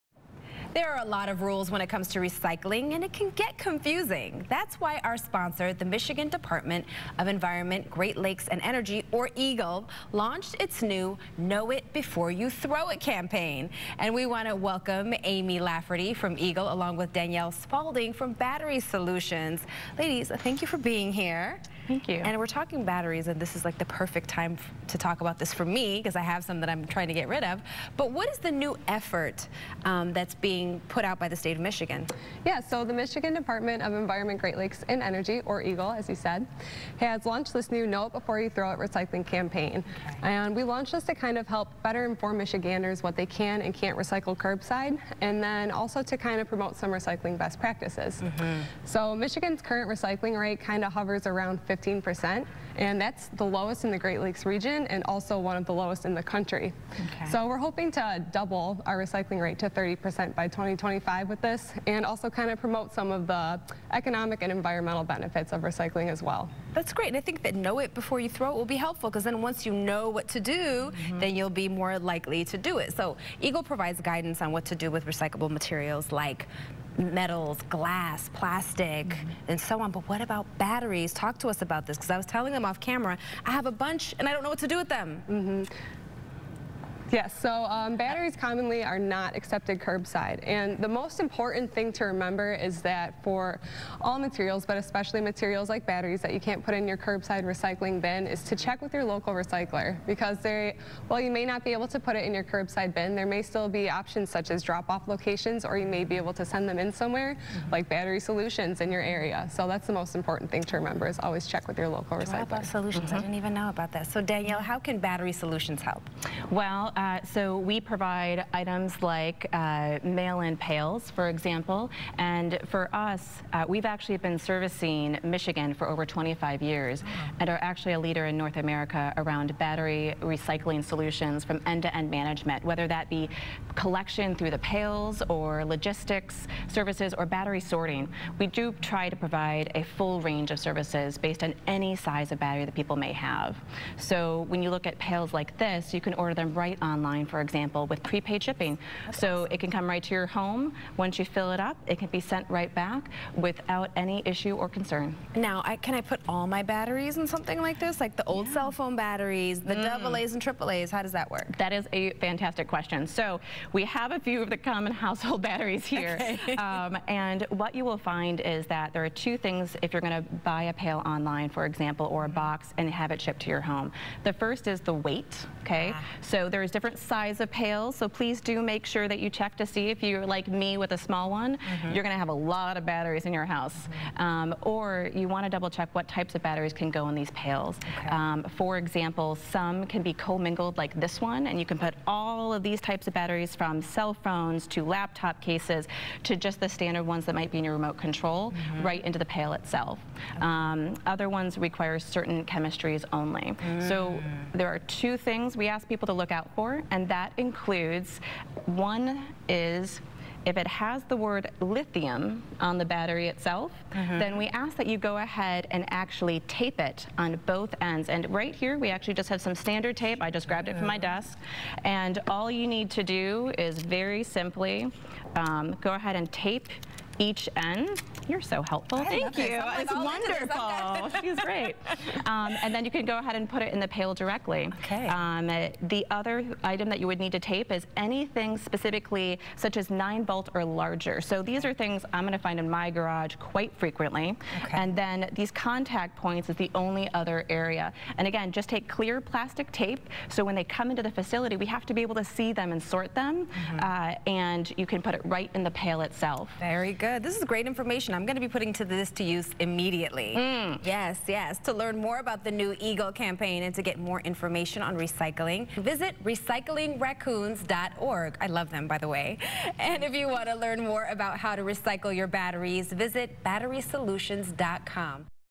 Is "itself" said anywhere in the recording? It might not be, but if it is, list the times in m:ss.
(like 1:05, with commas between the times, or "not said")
3:19, 3:33, 4:16.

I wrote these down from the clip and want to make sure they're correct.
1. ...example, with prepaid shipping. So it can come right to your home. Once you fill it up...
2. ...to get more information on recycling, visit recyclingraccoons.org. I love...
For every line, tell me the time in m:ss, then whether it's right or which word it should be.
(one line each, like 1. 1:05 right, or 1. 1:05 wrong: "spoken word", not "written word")
1. 2:27 right
2. 4:23 right.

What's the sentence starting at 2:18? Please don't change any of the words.
We do try to provide a full range of services based on any size of battery that people may have.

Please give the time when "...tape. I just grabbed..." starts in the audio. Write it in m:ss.
3:40.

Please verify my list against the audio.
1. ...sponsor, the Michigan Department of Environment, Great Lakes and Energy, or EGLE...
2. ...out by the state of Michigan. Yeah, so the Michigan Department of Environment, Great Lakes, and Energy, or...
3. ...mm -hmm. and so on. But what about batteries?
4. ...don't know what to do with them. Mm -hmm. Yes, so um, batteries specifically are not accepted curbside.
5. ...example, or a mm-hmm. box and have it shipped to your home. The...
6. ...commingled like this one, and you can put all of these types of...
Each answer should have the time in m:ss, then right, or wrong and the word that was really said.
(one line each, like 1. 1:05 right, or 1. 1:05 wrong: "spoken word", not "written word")
1. 0:05 right
2. 0:31 right
3. 1:19 right
4. 1:24 wrong: "commonly", not "specifically"
5. 2:51 right
6. 3:10 right.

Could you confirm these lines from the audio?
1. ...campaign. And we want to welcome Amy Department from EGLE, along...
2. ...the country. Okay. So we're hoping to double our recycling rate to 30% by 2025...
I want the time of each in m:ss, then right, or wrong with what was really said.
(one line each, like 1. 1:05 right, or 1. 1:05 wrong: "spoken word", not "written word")
1. 0:13 wrong: "Lafferty", not "Department"
2. 0:56 right.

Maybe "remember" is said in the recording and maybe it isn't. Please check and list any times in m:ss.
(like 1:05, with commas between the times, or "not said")
1:32, 1:50.